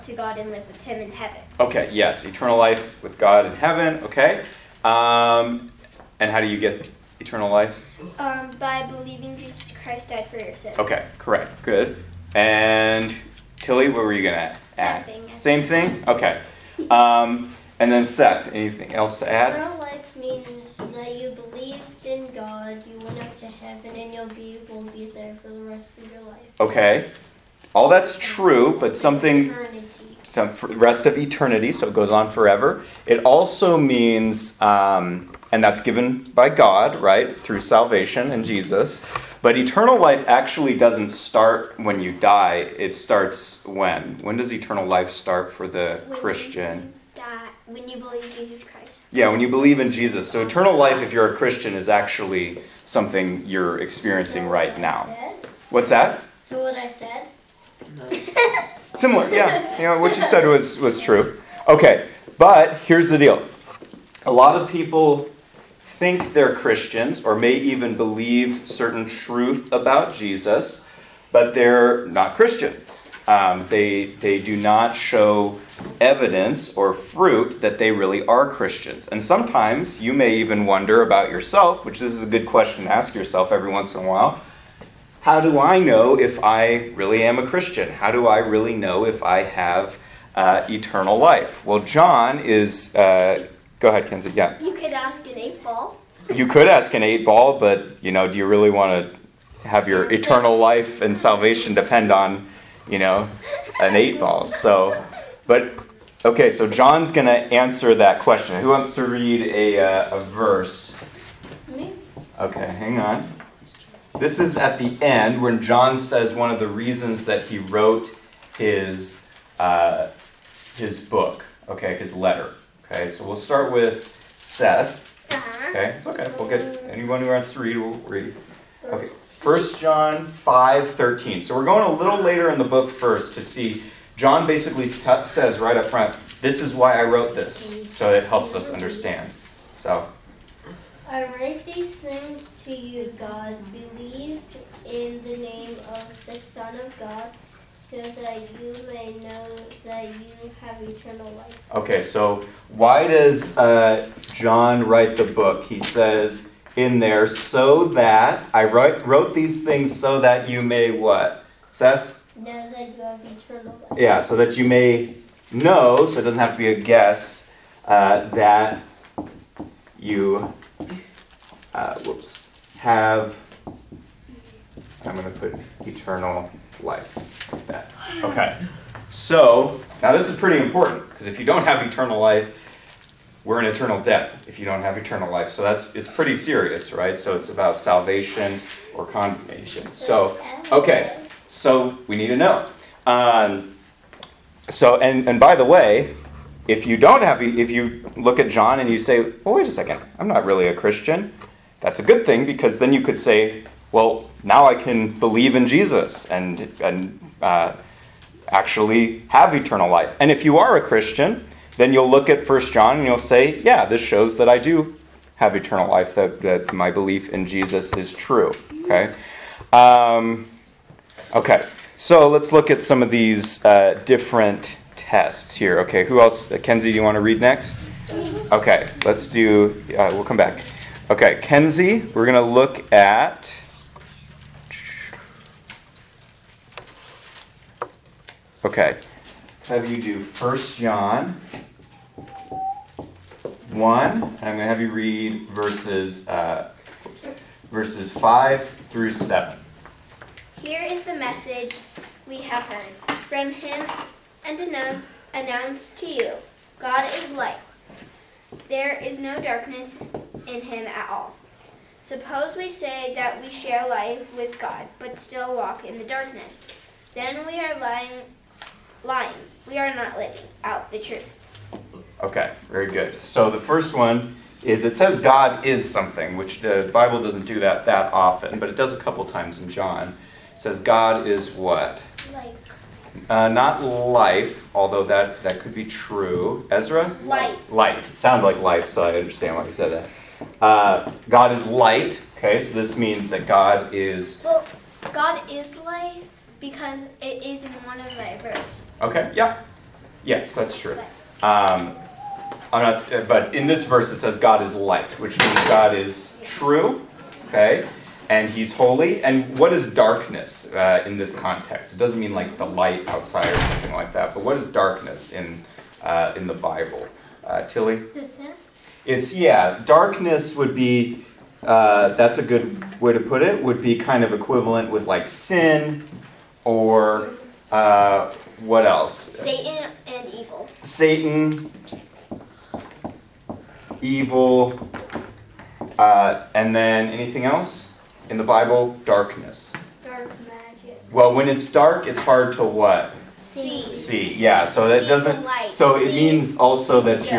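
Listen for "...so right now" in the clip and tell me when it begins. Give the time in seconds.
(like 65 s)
54 s.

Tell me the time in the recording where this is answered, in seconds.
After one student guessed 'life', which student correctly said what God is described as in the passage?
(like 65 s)
286 s.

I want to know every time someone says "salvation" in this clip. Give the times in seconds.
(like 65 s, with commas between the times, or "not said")
37 s, 101 s, 187 s.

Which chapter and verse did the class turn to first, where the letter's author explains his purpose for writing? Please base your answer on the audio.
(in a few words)
First John 5:13.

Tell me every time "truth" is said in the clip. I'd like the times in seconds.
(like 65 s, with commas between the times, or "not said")
69 s, 270 s.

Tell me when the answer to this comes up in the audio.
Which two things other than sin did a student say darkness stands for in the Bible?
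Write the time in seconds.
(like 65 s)
329 s.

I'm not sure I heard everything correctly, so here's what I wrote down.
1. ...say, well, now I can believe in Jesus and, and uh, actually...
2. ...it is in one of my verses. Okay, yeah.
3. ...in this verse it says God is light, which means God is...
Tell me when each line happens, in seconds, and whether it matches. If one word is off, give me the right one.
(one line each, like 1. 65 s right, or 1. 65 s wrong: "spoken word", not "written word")
1. 203 s right
2. 297 s right
3. 303 s right.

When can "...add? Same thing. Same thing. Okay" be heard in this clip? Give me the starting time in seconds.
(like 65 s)
14 s.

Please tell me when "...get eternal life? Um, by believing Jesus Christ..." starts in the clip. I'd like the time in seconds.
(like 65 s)
6 s.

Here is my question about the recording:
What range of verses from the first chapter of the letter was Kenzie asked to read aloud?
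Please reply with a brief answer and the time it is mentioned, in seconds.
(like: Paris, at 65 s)
Verses 5 through 7, at 247 s.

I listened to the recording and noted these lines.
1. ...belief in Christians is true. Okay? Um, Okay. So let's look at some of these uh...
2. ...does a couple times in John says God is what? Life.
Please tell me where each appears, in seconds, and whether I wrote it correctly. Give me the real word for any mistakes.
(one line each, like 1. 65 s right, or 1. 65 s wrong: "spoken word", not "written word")
1. 216 s wrong: "Jesus", not "Christians"
2. 278 s right.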